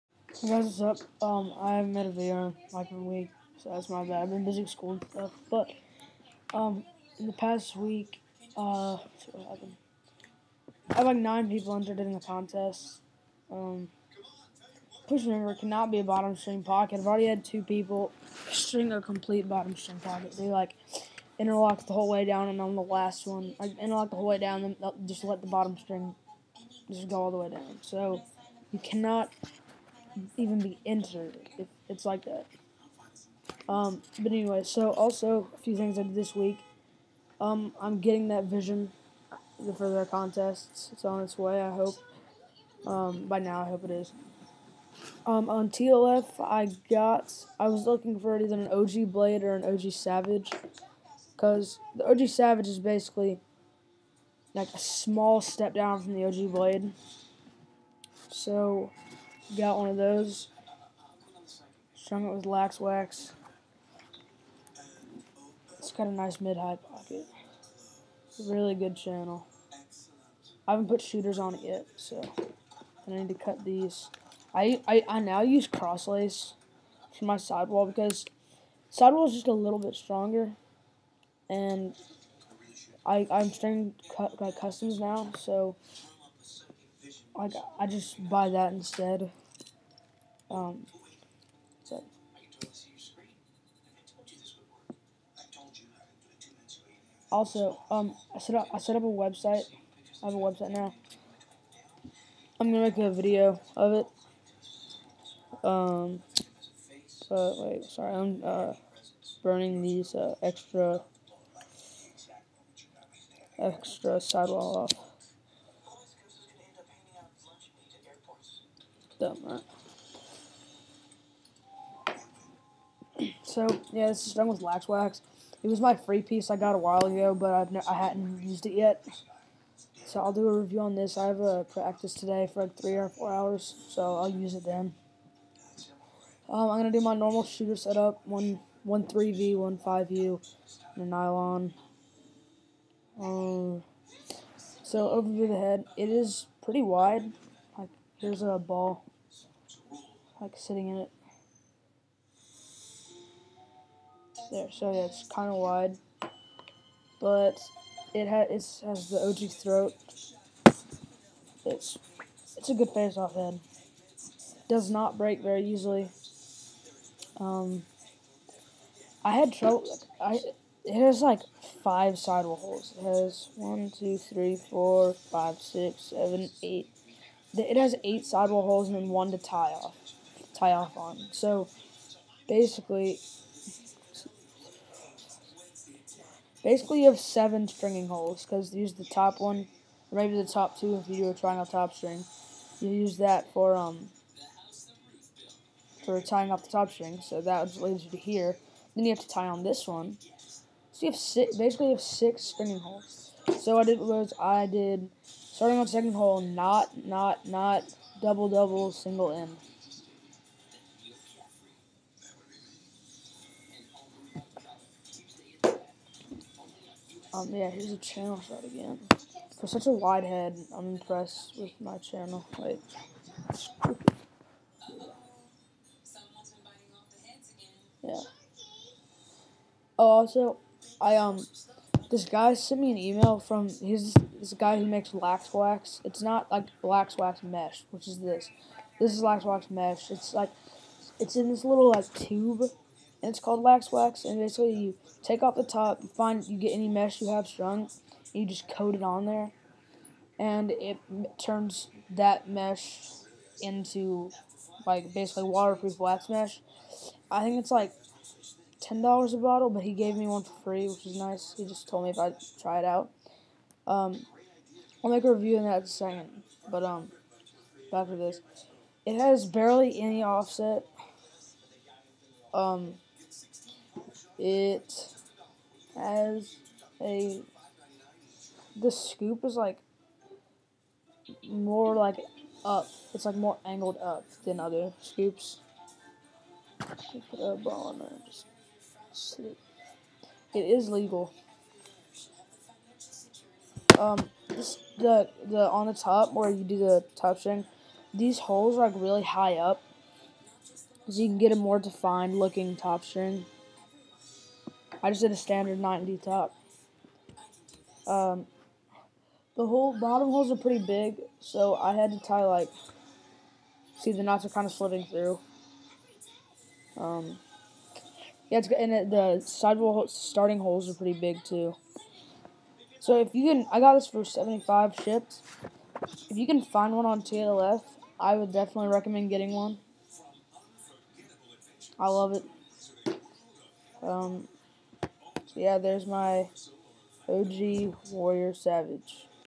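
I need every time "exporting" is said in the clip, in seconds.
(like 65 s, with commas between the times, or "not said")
not said.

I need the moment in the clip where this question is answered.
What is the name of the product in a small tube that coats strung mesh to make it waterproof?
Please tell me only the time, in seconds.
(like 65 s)
243 s.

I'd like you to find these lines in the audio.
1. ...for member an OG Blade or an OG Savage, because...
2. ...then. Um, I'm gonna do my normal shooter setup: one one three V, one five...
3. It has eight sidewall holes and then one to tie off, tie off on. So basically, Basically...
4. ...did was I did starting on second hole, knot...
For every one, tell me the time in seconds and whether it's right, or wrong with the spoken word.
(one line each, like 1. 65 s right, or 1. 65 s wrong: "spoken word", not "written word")
1. 48 s wrong: "either", not "member"
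2. 134 s right
3. 177 s right
4. 203 s right.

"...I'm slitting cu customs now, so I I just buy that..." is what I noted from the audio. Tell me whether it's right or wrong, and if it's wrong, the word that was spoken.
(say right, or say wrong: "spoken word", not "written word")
wrong: "stringing", not "slitting".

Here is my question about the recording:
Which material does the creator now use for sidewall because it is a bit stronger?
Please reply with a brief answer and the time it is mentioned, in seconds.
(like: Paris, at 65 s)
Crosslace, at 75 s.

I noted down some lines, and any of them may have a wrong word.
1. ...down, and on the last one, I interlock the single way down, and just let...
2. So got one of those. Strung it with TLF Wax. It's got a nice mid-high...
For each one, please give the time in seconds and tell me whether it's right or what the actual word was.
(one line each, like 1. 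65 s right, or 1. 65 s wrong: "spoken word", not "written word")
1. 22 s wrong: "whole", not "single"
2. 58 s wrong: "Lax", not "TLF".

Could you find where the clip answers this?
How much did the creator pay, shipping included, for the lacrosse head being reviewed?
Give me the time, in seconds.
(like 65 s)
324 s.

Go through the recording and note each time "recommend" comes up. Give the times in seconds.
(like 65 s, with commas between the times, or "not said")
328 s.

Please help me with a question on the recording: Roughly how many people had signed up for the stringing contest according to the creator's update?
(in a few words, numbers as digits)
9.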